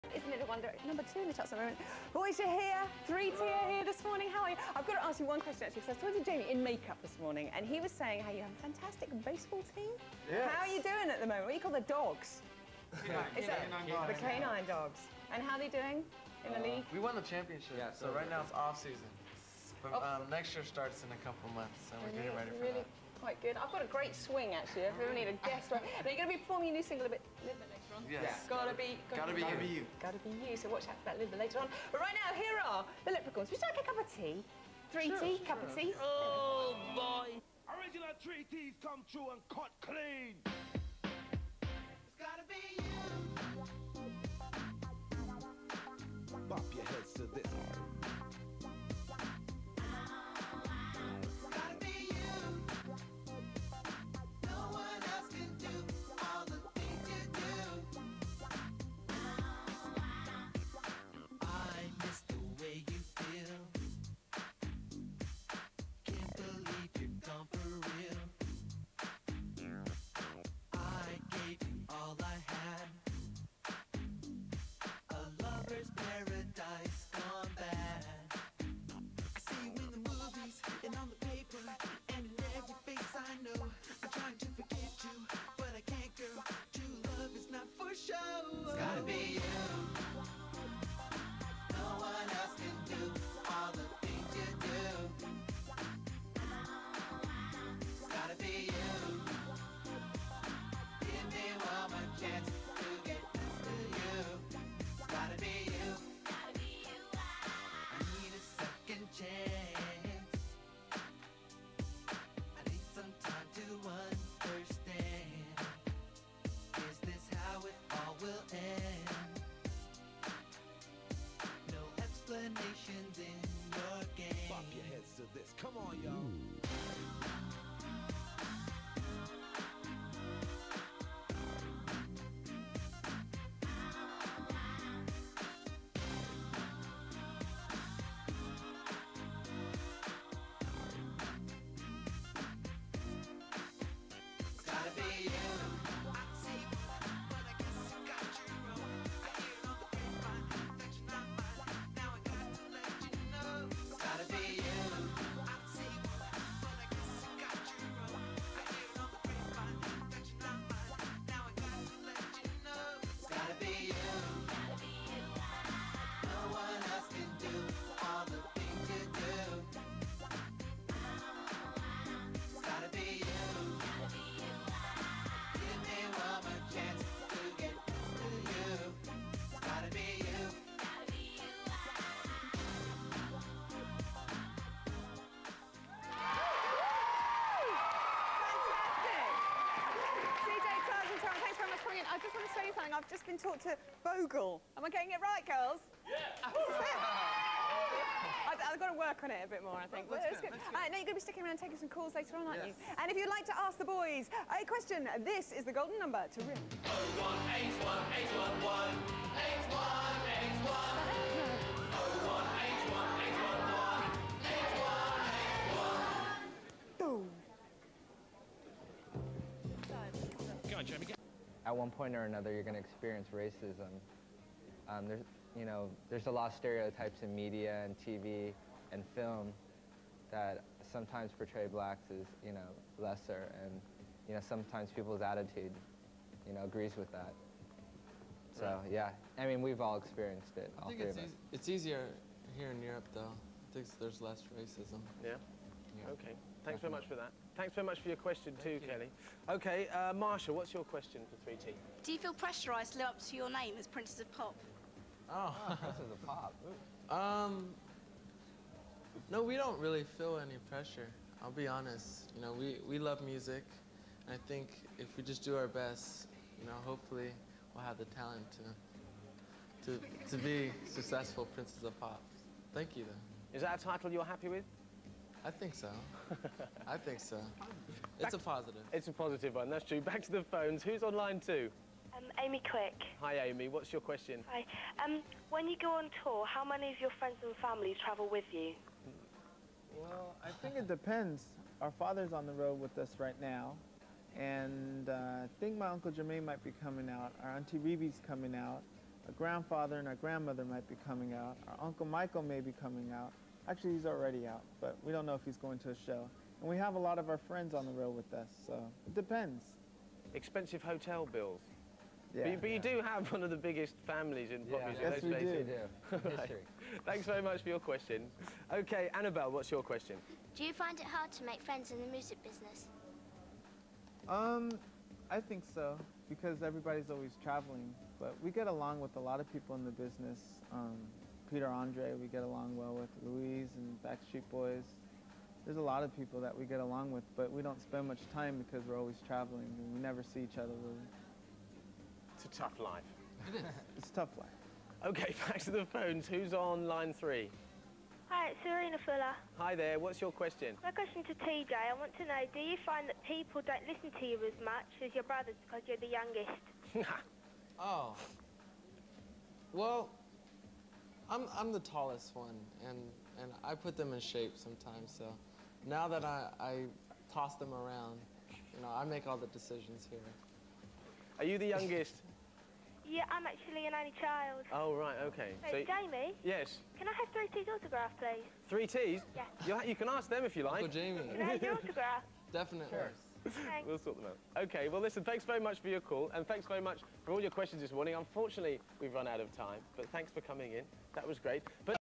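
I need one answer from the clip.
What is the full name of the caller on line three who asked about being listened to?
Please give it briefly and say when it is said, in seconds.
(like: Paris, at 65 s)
Serena Fuller, at 348 s.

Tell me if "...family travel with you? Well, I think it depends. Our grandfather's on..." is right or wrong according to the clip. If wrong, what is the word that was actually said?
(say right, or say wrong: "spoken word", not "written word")
wrong: "father", not "grandfather".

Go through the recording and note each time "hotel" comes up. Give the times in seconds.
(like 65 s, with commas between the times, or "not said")
310 s.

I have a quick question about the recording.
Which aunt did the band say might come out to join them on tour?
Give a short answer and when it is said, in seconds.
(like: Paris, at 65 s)
Auntie Rebbie, at 297 s.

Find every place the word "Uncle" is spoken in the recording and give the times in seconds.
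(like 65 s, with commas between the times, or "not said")
295 s, 301 s, 380 s.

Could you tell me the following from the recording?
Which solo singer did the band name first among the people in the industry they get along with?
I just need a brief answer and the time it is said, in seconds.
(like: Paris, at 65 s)
Peter Andre, at 331 s.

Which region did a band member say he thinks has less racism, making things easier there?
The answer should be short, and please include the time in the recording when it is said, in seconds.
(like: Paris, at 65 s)
Europe, at 242 s.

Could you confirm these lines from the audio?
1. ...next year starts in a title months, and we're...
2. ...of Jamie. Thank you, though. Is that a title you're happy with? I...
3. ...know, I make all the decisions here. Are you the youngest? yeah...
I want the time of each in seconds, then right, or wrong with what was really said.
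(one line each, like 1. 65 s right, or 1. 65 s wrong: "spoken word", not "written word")
1. 20 s wrong: "couple", not "title"
2. 271 s wrong: "Pop", not "Jamie"
3. 368 s right.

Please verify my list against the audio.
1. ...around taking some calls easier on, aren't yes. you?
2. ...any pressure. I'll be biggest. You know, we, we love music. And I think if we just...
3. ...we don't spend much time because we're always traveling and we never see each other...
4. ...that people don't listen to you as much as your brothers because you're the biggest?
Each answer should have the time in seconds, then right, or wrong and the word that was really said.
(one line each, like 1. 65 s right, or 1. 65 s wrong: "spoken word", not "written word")
1. 201 s wrong: "later", not "easier"
2. 260 s wrong: "honest", not "biggest"
3. 337 s right
4. 353 s wrong: "youngest", not "biggest".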